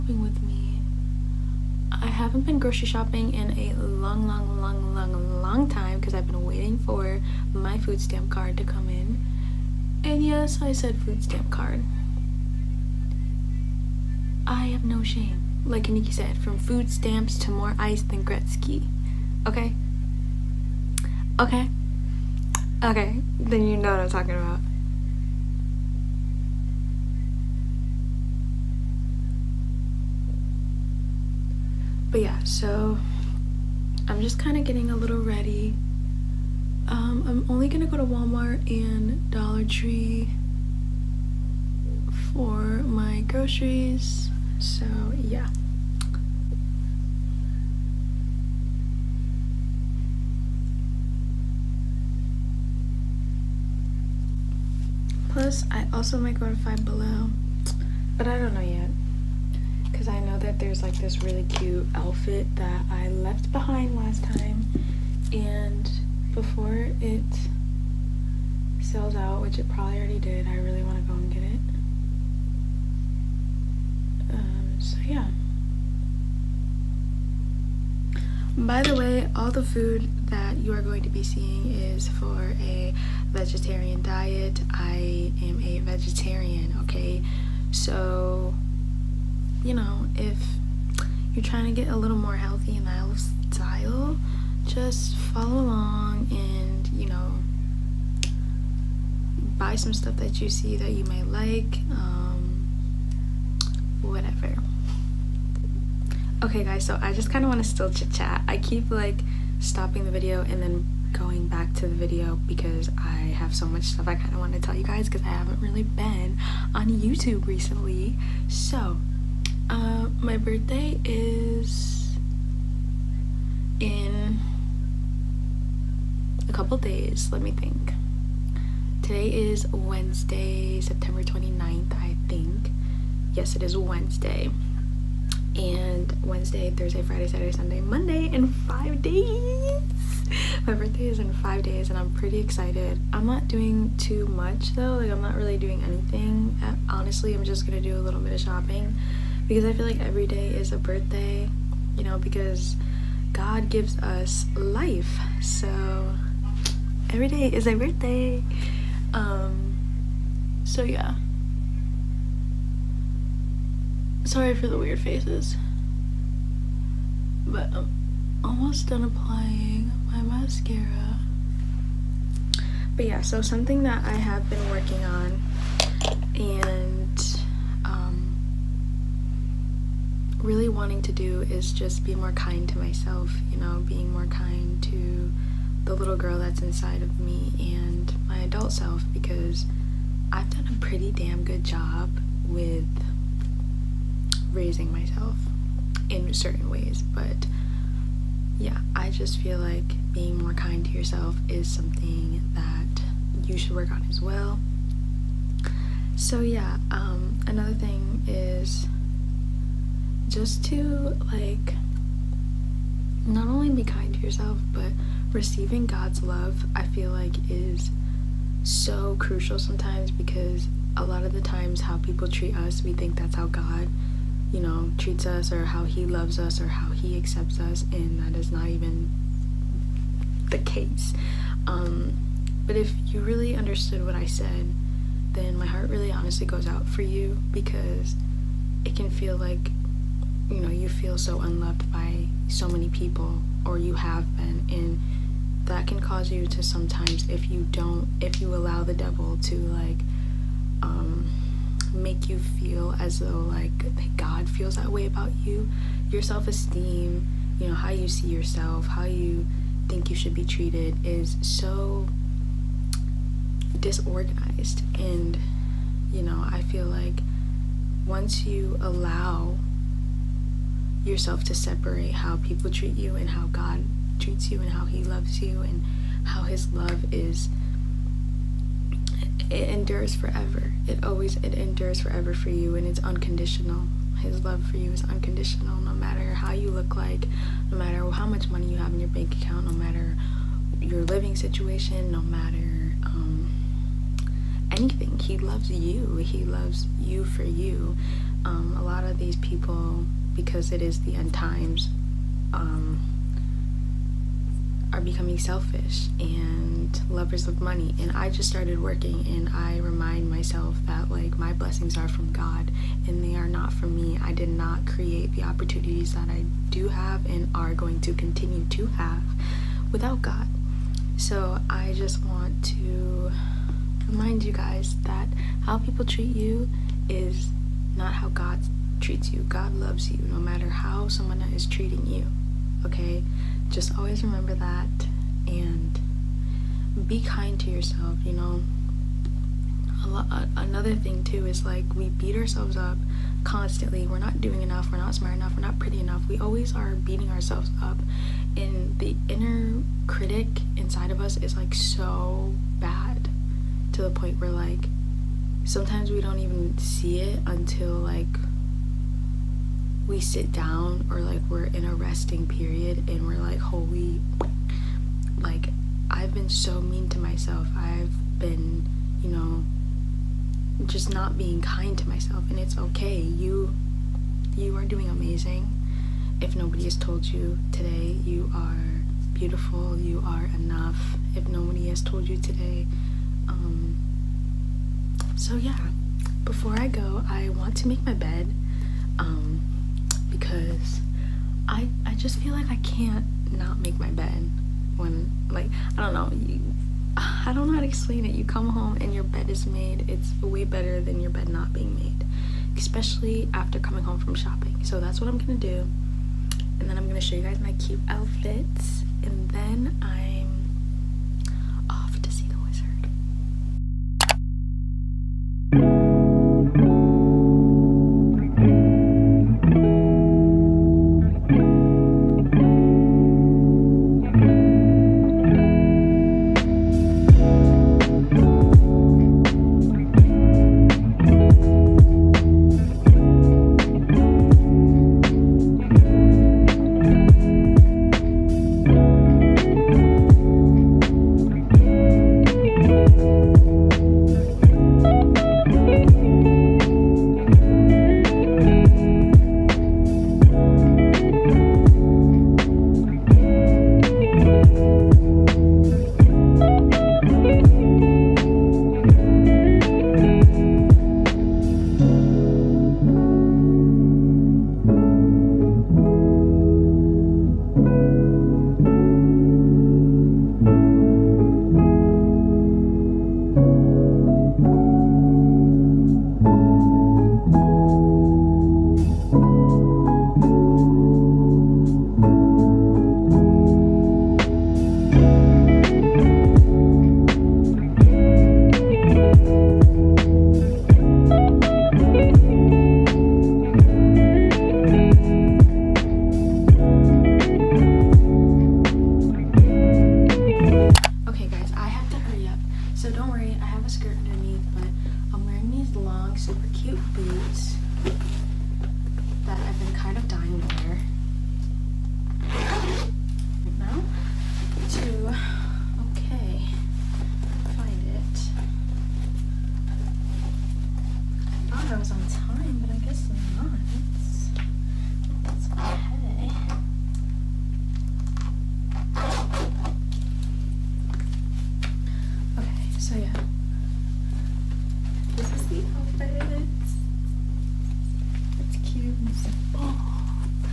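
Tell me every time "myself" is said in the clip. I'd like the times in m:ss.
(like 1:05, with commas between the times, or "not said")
3:02, 3:14, 5:10, 6:07, 6:12.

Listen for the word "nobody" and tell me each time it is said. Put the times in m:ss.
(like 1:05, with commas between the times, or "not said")
6:16, 6:21.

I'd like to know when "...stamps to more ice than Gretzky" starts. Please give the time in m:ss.
0:16.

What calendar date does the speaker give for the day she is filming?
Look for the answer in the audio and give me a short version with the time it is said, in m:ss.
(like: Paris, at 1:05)
September 29th, at 2:10.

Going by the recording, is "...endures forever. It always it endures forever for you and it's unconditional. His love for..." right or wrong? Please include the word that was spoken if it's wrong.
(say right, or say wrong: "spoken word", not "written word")
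right.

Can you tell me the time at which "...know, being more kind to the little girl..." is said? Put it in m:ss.
3:03.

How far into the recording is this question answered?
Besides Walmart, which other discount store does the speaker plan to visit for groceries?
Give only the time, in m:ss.
0:39.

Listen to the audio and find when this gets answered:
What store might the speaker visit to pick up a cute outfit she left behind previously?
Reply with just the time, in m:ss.
0:56.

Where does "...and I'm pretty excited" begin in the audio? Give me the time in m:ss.
2:21.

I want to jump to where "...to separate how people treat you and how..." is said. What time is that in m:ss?
4:31.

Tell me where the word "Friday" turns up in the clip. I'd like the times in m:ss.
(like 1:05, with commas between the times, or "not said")
2:17.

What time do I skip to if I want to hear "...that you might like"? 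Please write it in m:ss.
1:40.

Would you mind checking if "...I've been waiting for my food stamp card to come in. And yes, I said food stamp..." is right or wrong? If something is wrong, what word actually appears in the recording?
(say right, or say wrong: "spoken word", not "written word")
right.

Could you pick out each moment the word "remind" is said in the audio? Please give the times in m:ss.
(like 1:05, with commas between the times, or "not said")
5:09, 5:24.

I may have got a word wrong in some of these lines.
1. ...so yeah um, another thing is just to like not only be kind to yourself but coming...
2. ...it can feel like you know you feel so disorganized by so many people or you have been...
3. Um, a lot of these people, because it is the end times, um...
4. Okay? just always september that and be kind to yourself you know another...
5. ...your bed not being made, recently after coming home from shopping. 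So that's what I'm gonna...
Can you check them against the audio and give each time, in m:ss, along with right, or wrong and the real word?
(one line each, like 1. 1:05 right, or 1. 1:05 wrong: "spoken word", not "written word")
1. 3:26 wrong: "receiving", not "coming"
2. 3:58 wrong: "unloved", not "disorganized"
3. 4:58 right
4. 5:32 wrong: "remember", not "september"
5. 6:41 wrong: "especially", not "recently".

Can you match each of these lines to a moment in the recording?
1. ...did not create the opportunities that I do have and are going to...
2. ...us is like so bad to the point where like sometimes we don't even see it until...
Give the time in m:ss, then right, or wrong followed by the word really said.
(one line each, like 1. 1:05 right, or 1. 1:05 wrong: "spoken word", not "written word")
1. 5:14 right
2. 5:51 right.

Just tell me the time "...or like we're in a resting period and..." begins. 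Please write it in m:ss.
6:01.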